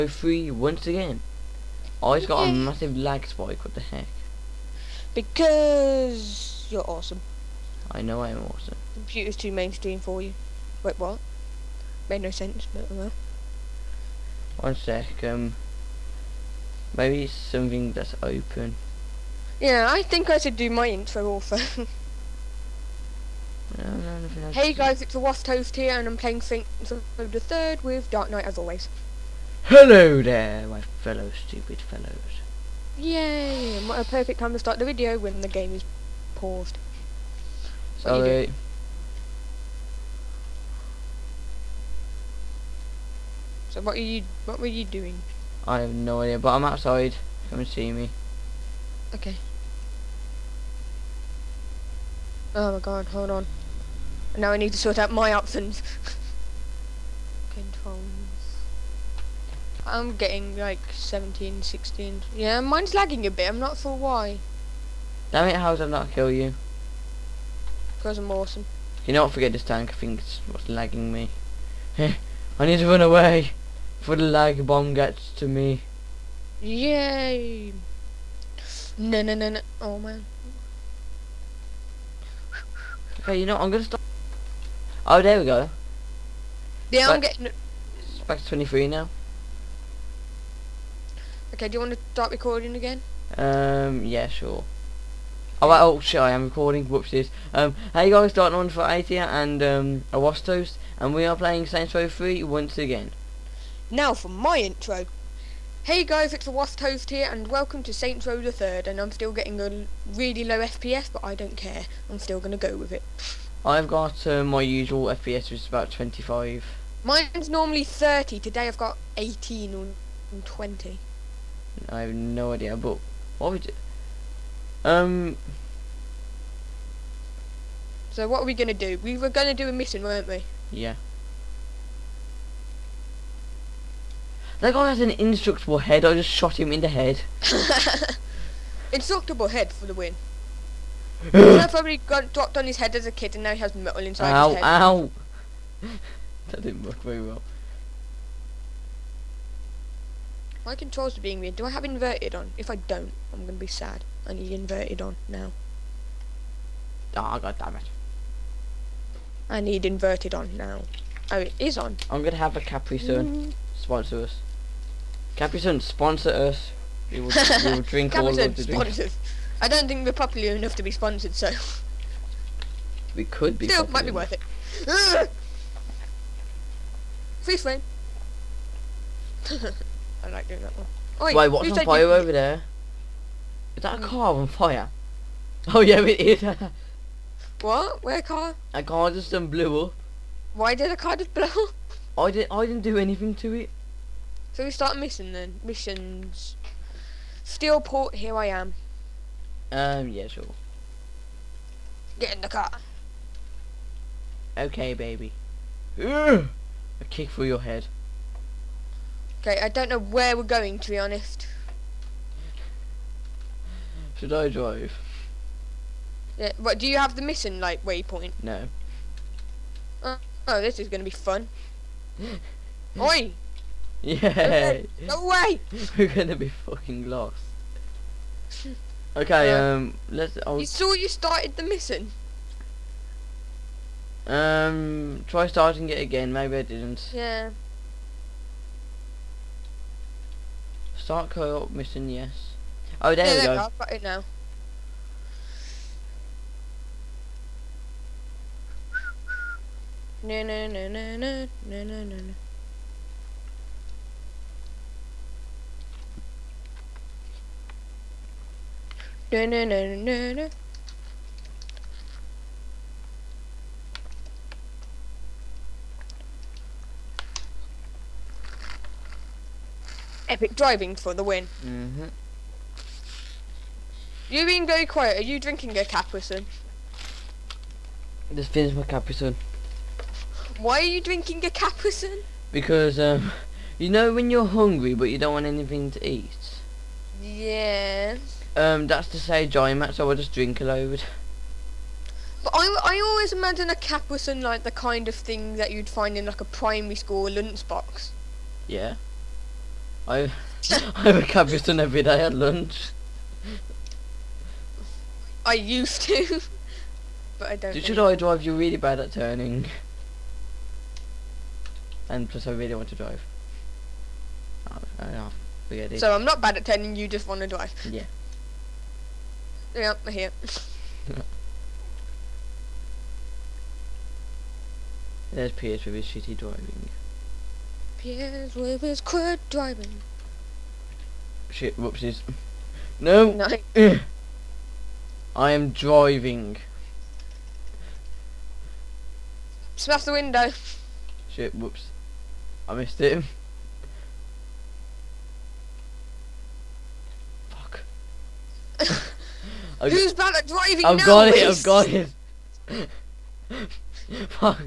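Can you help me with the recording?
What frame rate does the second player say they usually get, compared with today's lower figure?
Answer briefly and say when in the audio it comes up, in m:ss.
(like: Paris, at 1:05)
30, at 1:57.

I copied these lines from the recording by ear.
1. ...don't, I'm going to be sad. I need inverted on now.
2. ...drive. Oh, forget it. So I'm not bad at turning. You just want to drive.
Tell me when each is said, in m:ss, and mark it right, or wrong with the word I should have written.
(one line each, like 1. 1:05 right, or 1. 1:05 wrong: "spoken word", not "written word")
1. 2:32 right
2. 5:12 right.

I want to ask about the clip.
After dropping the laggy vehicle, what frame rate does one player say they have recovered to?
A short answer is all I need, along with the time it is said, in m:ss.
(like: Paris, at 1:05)
23, at 1:28.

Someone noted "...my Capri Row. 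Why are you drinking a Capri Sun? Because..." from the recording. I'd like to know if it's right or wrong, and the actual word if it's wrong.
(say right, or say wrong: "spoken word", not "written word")
wrong: "Sun", not "Row".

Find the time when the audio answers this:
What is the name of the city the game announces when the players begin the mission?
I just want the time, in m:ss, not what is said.
3:17.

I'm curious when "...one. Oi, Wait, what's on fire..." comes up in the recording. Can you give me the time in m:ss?
3:00.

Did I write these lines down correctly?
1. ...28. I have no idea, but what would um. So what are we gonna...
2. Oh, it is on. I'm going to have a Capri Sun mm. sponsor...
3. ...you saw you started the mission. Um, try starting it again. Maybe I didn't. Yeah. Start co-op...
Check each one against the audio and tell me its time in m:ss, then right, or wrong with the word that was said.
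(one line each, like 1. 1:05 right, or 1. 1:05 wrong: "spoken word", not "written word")
1. 2:00 wrong: "20", not "28"
2. 2:41 right
3. 3:50 right.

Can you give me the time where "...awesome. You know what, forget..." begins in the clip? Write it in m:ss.
1:08.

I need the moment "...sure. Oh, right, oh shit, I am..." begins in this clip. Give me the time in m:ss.
1:34.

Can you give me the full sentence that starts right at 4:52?
But I, I always imagine a cap like the kind of thing that you'd find in like a primary school lunchbox.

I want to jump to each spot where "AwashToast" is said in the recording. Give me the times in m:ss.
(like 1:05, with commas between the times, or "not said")
0:25, 1:40, 1:46.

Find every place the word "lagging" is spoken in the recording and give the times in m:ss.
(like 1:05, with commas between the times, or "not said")
1:02, 1:10.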